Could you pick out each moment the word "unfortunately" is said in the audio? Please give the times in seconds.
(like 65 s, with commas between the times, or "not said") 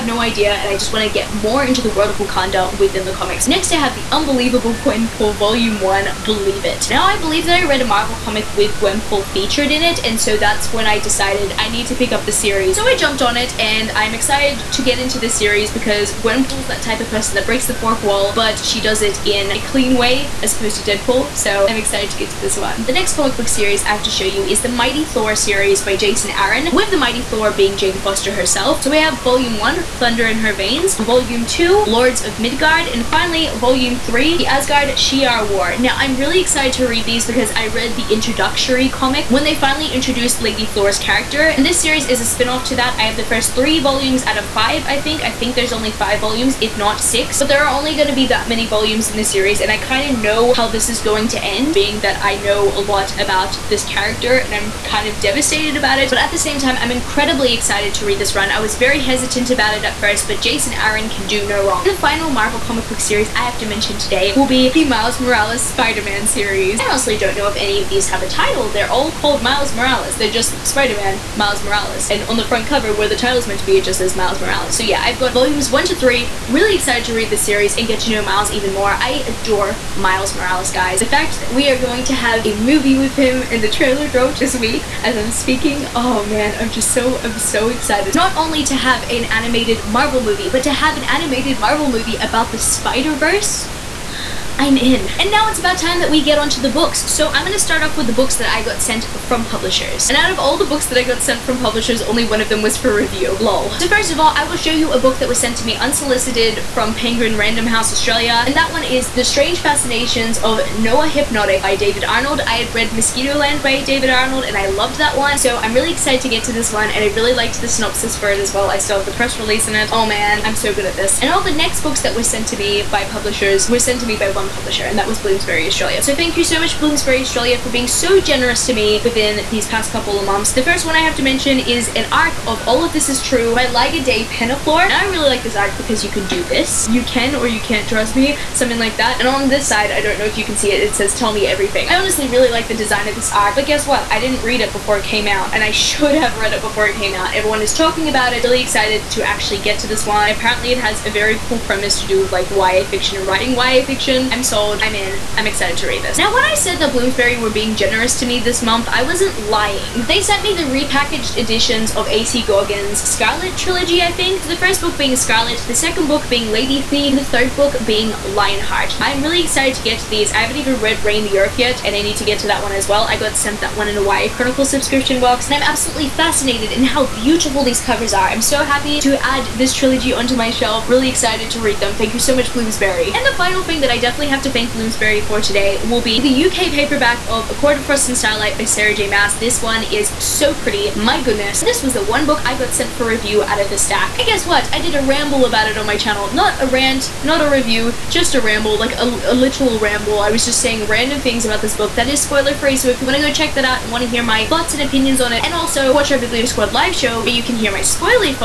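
not said.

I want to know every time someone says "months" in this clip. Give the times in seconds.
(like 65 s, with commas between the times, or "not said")
130 s, 158 s.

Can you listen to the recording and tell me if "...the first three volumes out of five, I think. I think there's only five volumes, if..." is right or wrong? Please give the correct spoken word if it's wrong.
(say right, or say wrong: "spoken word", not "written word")
right.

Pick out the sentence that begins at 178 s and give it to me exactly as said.
I'm so happy to add this trilogy onto my shelf.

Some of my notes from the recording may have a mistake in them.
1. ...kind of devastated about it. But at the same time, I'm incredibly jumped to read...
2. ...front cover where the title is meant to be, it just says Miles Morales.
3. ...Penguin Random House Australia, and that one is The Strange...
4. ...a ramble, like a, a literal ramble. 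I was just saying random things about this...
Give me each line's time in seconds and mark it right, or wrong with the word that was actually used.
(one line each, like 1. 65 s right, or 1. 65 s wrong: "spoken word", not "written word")
1. 54 s wrong: "excited", not "jumped"
2. 72 s right
3. 106 s right
4. 198 s right.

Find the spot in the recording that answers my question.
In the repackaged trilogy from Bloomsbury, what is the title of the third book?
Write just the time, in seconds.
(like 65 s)
168 s.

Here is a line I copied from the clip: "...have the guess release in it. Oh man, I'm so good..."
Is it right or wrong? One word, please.
wrong.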